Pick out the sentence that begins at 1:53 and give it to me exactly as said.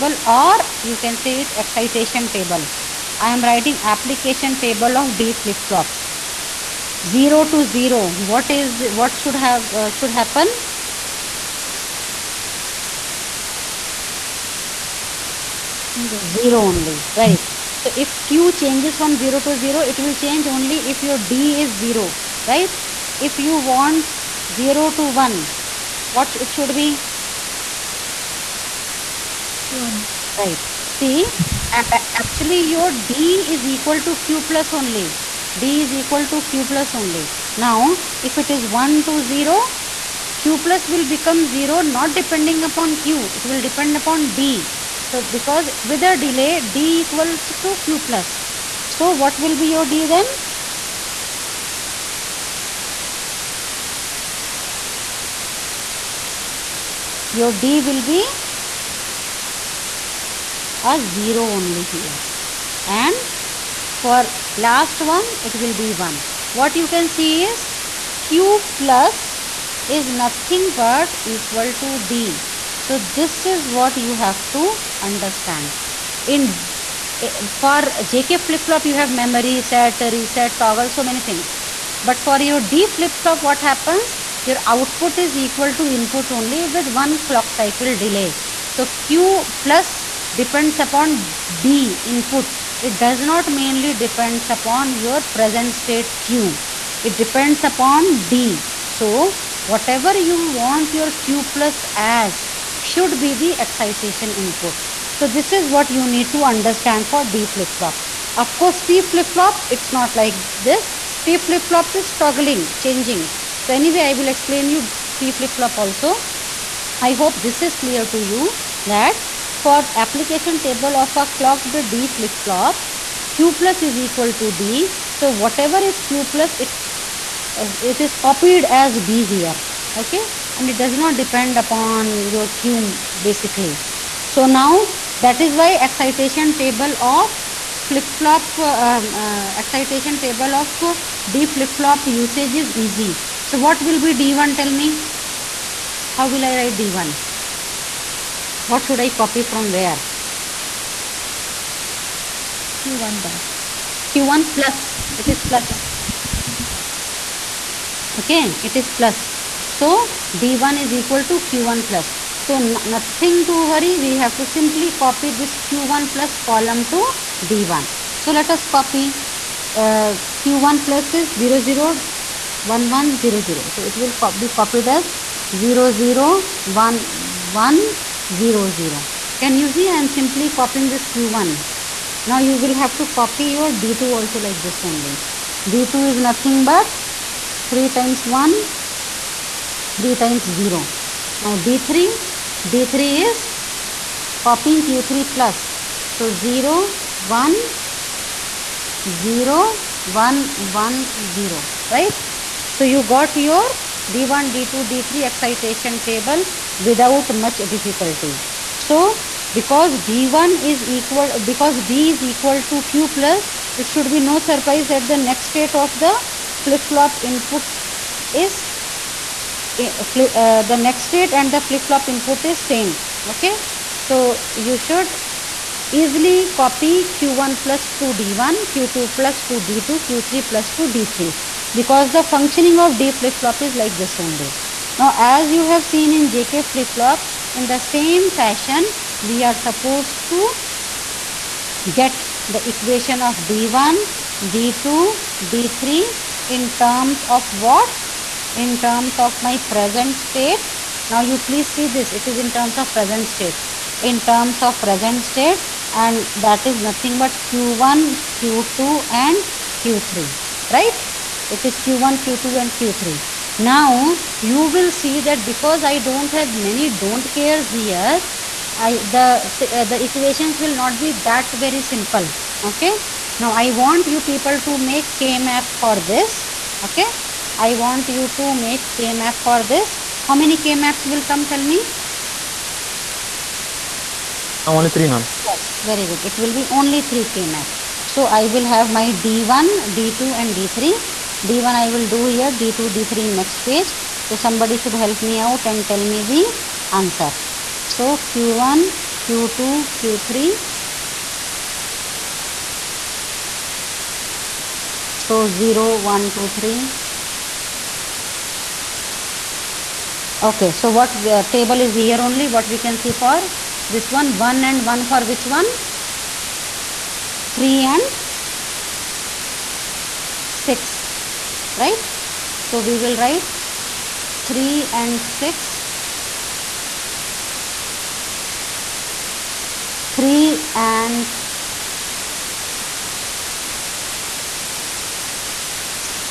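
So anyway, I will explain you T flip-flop also.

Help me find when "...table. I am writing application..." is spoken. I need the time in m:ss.
0:02.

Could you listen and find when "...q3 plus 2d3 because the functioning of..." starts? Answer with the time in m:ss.
3:50.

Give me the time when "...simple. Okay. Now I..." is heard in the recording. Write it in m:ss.
4:31.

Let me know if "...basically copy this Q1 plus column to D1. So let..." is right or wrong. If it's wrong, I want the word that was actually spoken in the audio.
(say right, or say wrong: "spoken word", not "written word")
wrong: "simply", not "basically".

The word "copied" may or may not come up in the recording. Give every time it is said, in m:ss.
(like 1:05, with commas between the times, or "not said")
2:08, 2:54.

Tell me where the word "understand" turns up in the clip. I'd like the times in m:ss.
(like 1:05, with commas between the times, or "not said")
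1:15, 1:46.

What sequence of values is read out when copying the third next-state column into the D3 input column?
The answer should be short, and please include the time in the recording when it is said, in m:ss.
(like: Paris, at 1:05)
0, 1, 0, 1, 1, 0, at 3:16.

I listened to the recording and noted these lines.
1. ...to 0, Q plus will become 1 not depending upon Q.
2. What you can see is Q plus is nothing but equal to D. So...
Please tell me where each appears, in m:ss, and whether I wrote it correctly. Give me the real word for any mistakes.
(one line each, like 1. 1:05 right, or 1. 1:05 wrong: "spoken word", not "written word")
1. 0:39 wrong: "0", not "1"
2. 1:06 right.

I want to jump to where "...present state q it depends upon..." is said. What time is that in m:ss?
1:35.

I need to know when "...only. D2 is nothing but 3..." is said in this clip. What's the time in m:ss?
3:04.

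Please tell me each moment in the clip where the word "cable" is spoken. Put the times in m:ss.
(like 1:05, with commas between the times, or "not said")
not said.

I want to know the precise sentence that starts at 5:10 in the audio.
Okay, so what table is here only?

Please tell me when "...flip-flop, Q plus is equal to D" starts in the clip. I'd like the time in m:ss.
2:02.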